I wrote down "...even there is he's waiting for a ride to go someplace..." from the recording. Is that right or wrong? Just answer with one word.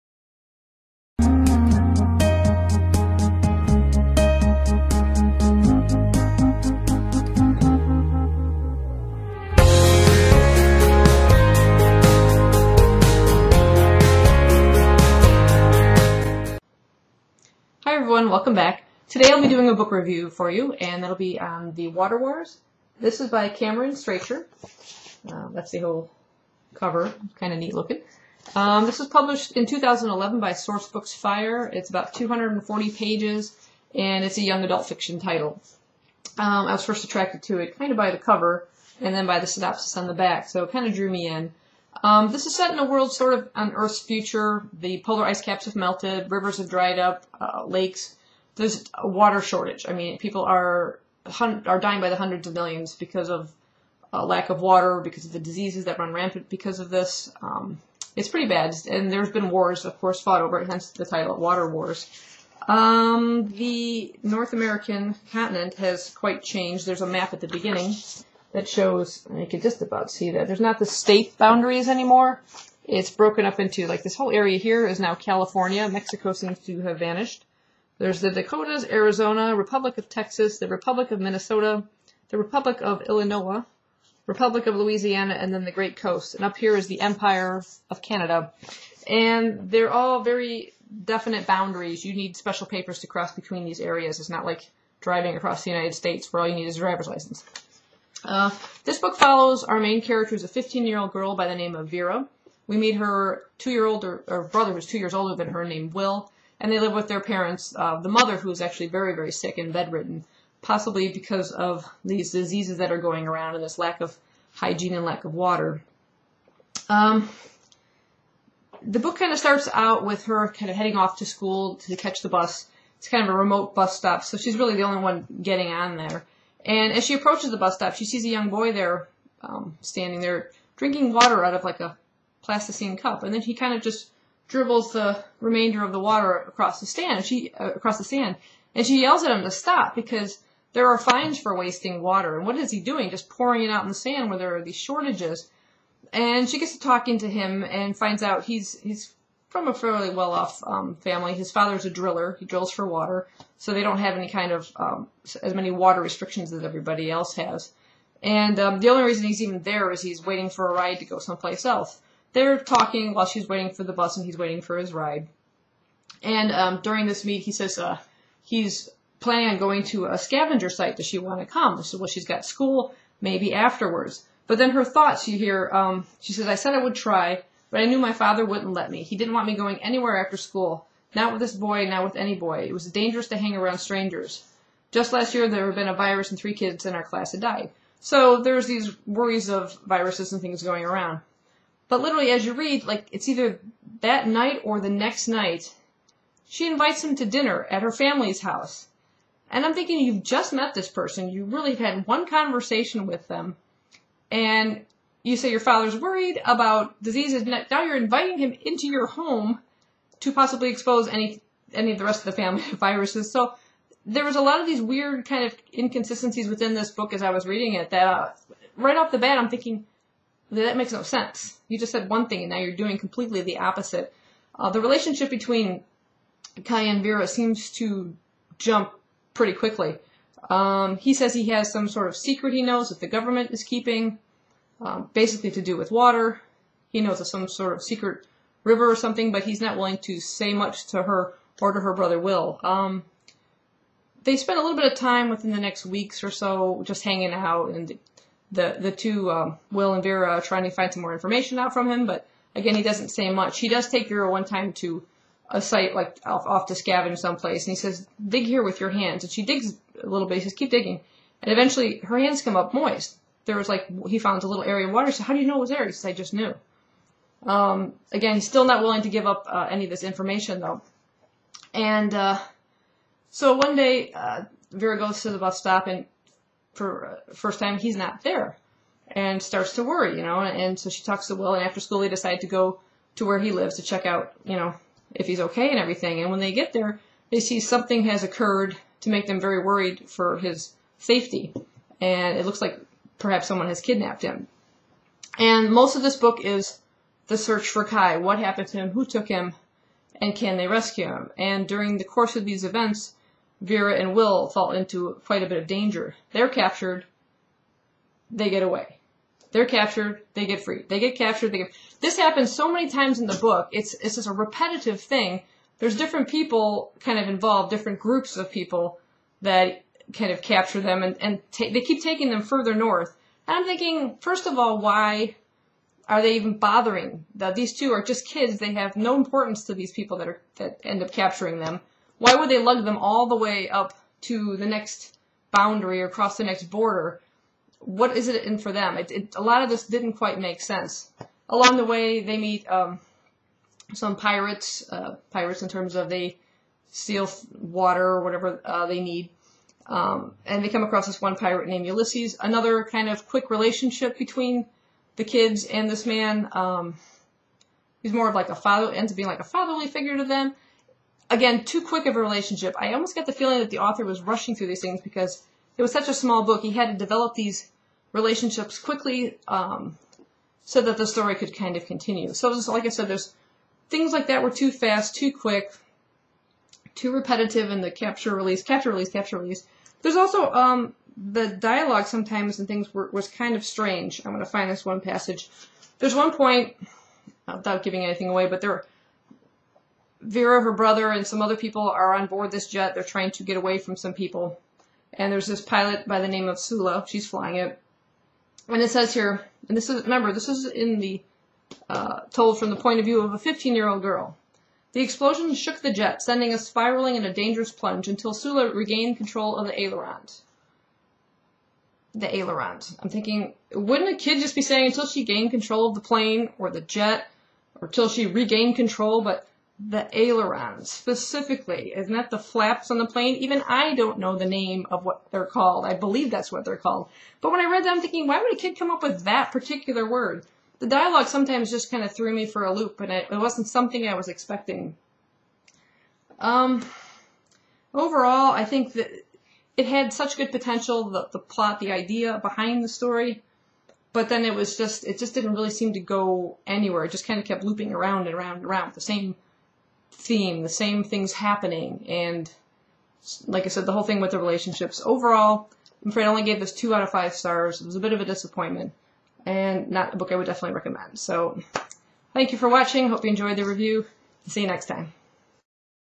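right.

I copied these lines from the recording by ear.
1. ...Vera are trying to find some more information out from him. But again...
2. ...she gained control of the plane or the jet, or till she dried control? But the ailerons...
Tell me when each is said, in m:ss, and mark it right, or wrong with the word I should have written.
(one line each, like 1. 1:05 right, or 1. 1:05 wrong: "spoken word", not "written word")
1. 4:10 right
2. 6:55 wrong: "regained", not "dried".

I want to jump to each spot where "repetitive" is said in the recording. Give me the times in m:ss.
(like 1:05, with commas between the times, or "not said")
5:14, 6:17.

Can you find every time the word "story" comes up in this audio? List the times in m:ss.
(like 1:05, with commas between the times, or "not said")
6:11, 7:22.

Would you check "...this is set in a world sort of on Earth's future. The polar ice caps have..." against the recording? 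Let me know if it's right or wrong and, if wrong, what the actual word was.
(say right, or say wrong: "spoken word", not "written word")
right.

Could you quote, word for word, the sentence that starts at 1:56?
Um, the book kind of starts out with her kind of heading off to school to catch the bus.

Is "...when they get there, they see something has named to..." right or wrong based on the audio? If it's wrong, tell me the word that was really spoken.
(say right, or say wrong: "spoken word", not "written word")
wrong: "occurred", not "named".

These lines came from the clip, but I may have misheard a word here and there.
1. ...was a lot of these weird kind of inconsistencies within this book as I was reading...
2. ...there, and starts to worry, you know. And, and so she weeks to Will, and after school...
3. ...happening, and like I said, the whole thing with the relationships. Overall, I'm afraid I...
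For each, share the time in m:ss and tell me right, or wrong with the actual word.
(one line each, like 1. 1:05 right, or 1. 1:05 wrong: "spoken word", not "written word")
1. 3:34 right
2. 4:38 wrong: "talks", not "weeks"
3. 7:31 right.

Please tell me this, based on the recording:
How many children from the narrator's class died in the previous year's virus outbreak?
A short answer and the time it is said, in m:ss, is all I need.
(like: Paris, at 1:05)
3, at 3:06.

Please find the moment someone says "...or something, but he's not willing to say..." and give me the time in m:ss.
3:58.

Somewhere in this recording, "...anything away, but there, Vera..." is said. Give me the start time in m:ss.
6:28.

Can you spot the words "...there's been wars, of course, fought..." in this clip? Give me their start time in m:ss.
0:59.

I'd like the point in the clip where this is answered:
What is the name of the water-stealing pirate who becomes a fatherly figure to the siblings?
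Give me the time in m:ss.
5:51.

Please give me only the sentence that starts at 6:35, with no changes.
And there's this pilot by the name of Sula.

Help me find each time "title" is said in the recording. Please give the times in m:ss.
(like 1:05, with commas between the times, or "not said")
0:35, 1:01.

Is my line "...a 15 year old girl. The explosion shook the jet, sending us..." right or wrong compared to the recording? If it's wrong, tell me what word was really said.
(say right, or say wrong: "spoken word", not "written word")
right.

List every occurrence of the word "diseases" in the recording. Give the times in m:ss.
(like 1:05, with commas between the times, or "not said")
0:55, 1:52, 3:27.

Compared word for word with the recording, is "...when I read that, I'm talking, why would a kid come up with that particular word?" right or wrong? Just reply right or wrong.
wrong.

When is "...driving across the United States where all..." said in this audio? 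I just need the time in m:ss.
1:34.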